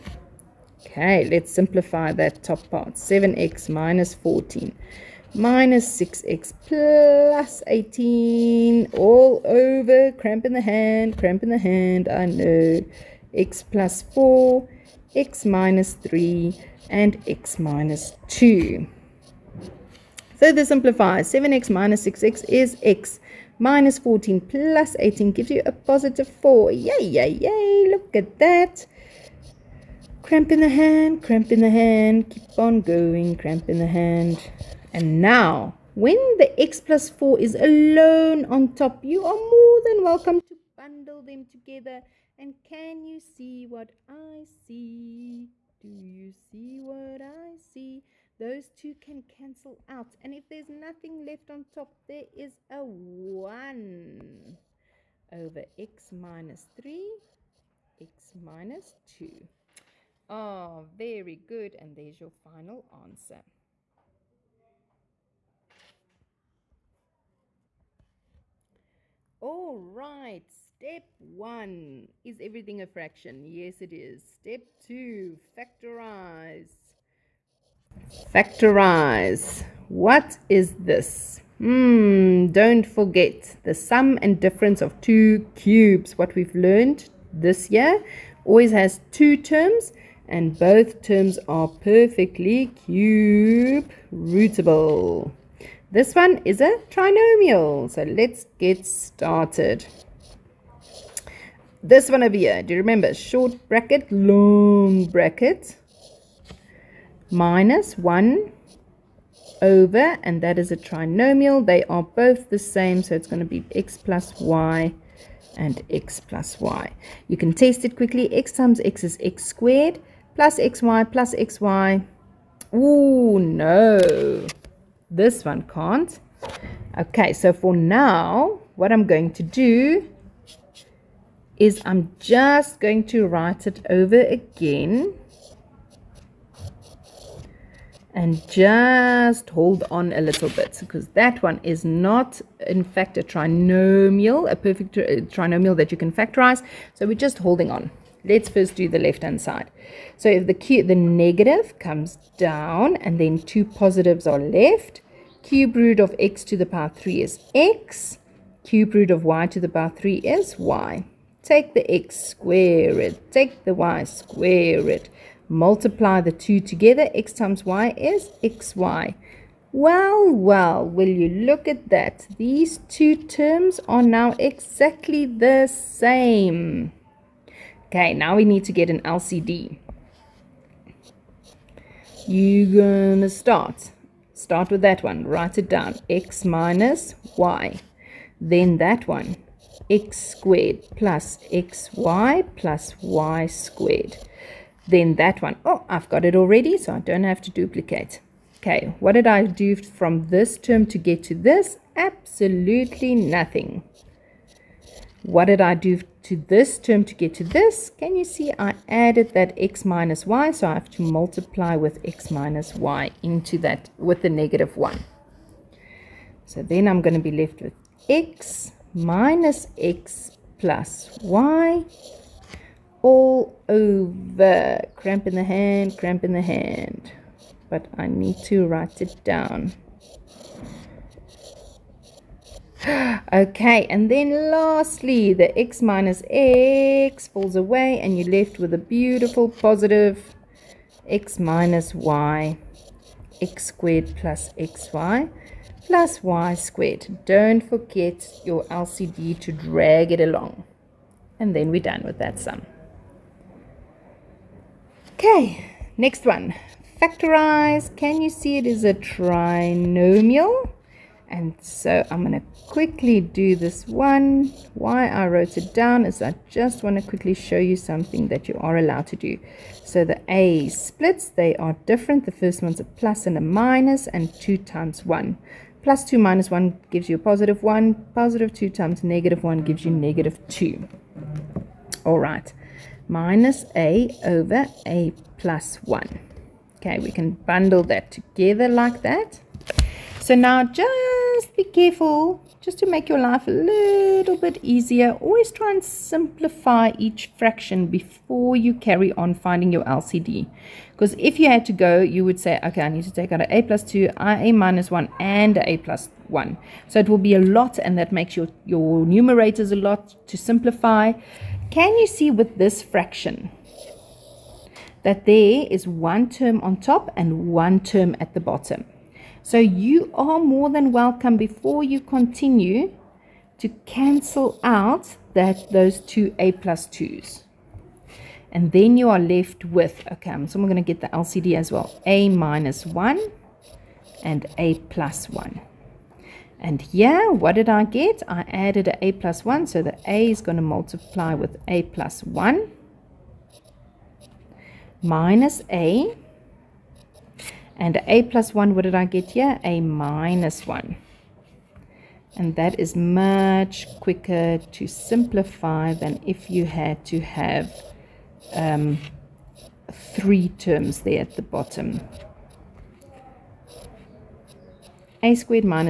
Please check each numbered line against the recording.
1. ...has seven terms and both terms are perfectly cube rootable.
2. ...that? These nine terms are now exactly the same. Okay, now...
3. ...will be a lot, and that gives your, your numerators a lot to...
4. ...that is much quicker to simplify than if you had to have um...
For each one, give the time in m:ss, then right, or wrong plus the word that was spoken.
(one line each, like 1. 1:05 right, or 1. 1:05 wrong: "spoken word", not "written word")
1. 1:28 wrong: "two", not "seven"
2. 2:51 wrong: "two", not "nine"
3. 5:07 wrong: "makes", not "gives"
4. 5:52 right.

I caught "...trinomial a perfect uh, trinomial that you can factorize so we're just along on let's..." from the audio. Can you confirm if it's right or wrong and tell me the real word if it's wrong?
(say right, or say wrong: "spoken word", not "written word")
wrong: "holding", not "along".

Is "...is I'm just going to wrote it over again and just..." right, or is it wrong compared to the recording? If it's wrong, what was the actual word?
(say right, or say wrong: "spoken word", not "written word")
wrong: "write", not "wrote".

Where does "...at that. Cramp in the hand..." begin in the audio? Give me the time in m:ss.
0:28.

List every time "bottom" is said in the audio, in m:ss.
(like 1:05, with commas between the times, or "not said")
5:18, 6:01.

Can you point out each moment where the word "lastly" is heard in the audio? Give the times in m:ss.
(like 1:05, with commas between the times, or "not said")
3:54.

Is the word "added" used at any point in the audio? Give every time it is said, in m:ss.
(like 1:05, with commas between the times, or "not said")
3:28, 5:38.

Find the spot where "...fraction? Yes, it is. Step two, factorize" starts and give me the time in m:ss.
1:12.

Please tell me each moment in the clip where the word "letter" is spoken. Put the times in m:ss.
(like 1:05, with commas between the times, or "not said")
not said.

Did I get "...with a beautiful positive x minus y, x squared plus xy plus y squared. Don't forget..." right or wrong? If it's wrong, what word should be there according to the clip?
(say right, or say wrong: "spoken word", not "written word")
right.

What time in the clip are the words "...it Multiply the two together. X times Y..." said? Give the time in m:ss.
2:44.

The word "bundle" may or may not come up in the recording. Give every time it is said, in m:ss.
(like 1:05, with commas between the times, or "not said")
0:40, 4:47.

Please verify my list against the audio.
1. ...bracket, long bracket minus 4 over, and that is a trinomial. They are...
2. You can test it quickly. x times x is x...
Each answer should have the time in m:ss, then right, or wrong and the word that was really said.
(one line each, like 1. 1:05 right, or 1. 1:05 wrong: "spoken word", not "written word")
1. 1:43 wrong: "1", not "4"
2. 1:57 right.